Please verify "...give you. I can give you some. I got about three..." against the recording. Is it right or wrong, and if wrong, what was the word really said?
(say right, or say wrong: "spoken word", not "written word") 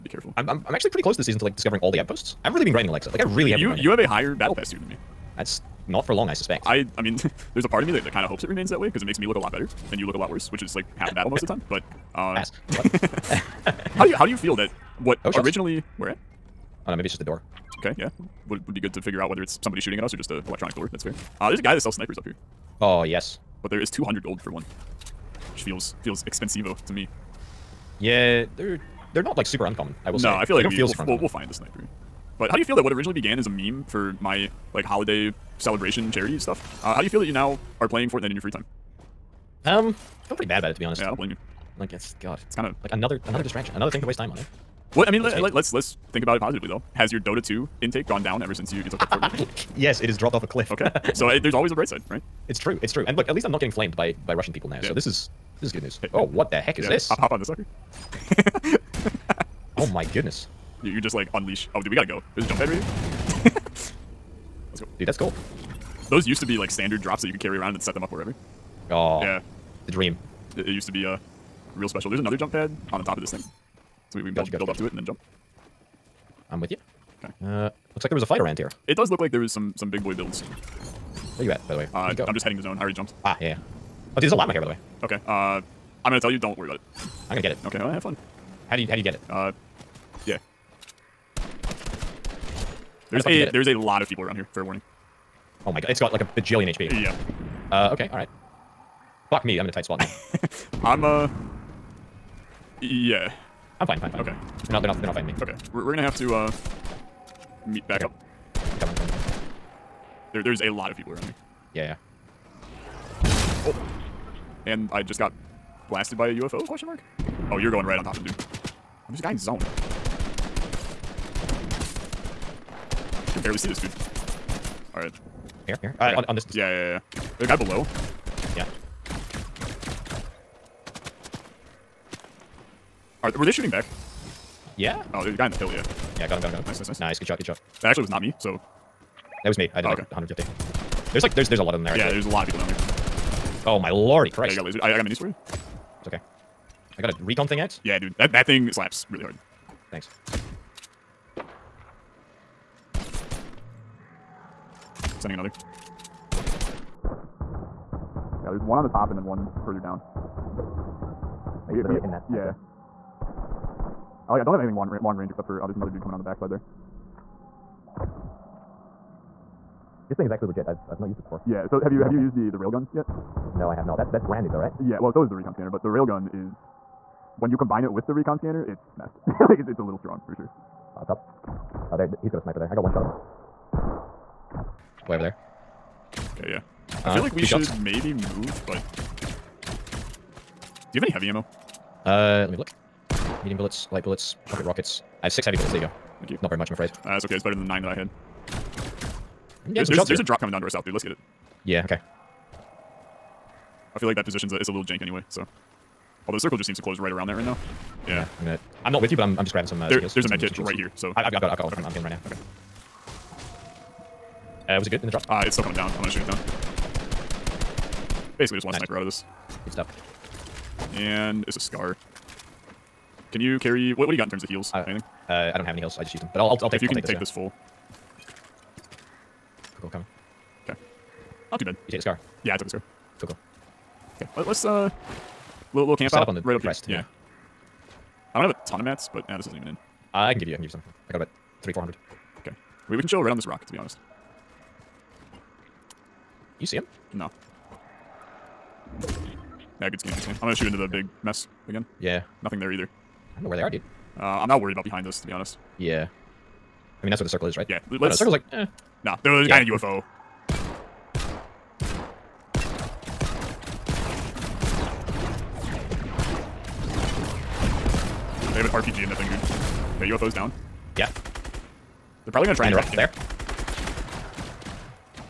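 right.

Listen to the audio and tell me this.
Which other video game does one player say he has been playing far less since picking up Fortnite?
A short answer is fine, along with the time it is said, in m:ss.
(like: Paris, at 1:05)
Dota 2, at 0:47.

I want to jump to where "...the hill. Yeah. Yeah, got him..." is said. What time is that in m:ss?
2:15.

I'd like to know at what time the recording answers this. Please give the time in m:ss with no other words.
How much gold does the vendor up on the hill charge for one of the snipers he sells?
0:23.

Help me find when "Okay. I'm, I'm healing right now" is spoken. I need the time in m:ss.
3:31.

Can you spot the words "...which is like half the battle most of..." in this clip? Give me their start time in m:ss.
0:10.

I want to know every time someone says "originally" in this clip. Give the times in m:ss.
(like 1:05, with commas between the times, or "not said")
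0:15, 0:32.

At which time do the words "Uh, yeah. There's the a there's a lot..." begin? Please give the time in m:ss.
1:29.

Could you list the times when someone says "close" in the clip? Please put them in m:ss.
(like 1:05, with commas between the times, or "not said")
0:01, 3:26.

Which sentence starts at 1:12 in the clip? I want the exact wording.
There's another jump pad on the top of this thing.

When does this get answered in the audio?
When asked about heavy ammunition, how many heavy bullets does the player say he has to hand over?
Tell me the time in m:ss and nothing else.
3:15.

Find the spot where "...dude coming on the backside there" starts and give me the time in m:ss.
2:45.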